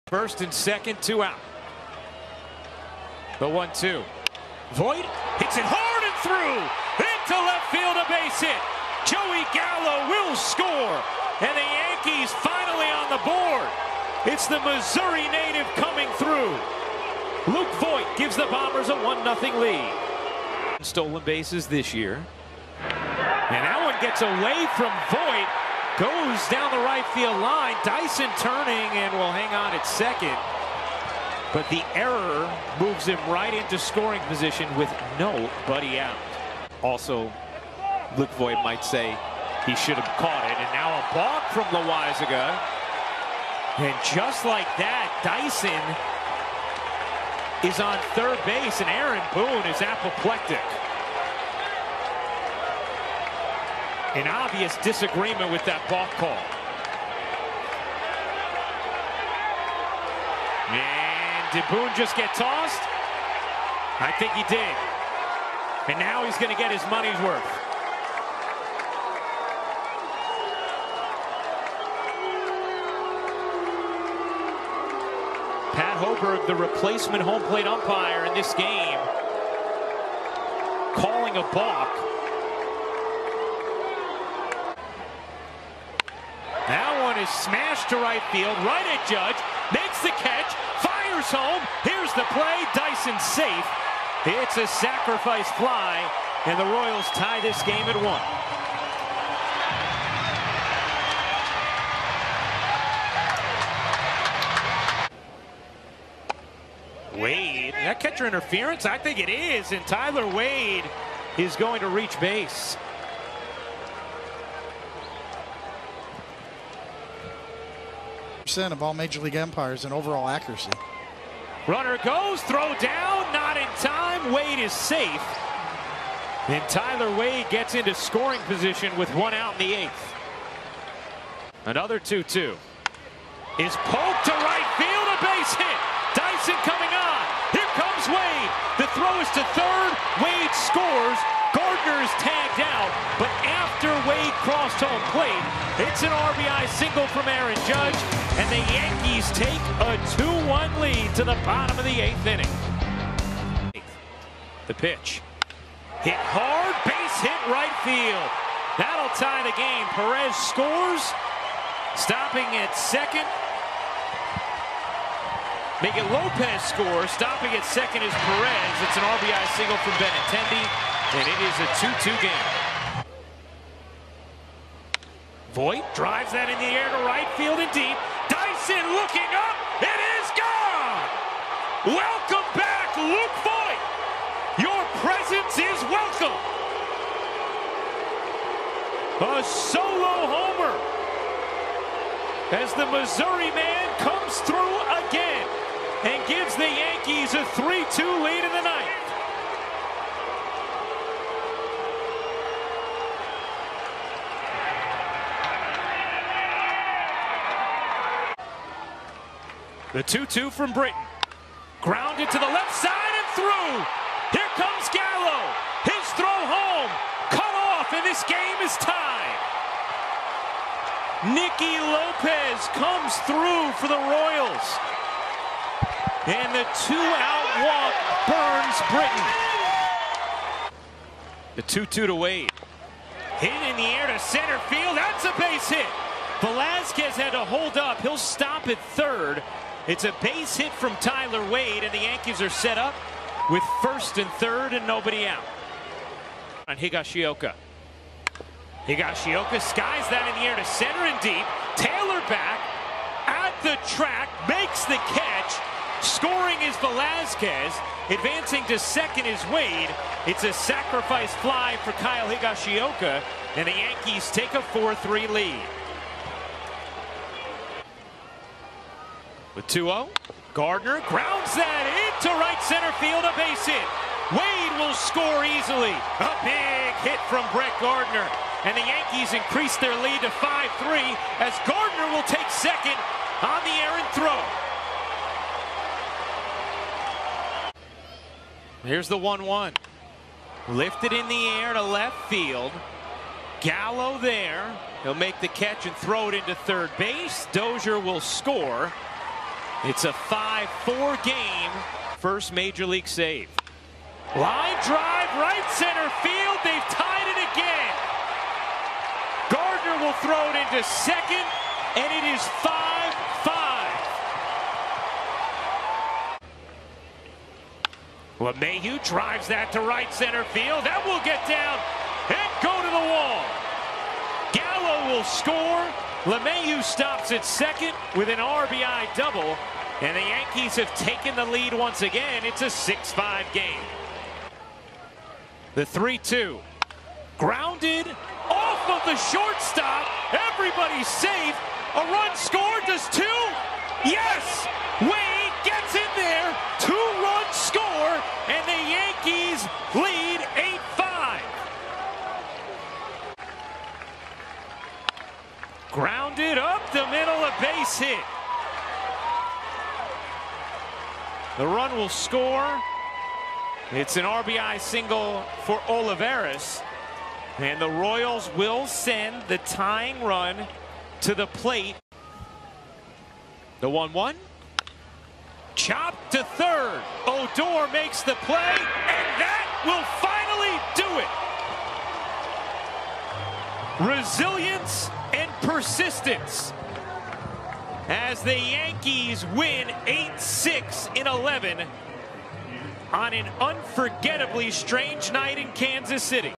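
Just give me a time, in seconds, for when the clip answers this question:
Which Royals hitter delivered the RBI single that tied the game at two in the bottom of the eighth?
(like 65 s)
169 s.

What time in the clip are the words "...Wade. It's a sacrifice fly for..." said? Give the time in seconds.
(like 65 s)
259 s.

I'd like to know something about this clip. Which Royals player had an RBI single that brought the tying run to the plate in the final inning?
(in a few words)
Olivares.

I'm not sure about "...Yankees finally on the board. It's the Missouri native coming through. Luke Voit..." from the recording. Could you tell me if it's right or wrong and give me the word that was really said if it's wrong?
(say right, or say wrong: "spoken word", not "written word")
right.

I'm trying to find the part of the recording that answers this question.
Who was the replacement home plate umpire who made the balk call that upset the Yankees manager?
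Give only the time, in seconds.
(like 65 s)
75 s.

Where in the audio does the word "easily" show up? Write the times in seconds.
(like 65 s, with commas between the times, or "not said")
275 s.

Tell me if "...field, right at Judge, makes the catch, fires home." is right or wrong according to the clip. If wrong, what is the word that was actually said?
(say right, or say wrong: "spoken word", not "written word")
right.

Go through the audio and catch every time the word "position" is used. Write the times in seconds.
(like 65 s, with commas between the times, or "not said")
34 s, 128 s.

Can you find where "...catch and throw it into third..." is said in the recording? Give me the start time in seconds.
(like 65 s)
295 s.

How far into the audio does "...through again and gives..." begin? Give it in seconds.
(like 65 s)
194 s.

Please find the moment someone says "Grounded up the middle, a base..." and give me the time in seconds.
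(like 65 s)
355 s.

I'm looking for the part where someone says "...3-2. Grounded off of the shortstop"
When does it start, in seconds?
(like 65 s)
335 s.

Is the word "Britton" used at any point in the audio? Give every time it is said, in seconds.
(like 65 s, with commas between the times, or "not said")
210 s, 228 s.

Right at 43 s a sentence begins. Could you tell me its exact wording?
And just like that, Dyson is on third base, and Aaron Boone is apoplectic.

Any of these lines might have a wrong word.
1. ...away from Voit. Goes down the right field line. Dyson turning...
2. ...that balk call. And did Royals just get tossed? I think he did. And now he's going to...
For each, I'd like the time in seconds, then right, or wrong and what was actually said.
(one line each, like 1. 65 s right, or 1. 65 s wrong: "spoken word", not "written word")
1. 24 s right
2. 55 s wrong: "Boone", not "Royals".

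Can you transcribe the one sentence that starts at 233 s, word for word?
Hit in the air to center field.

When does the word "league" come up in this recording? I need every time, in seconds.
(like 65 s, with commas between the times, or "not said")
119 s, 302 s.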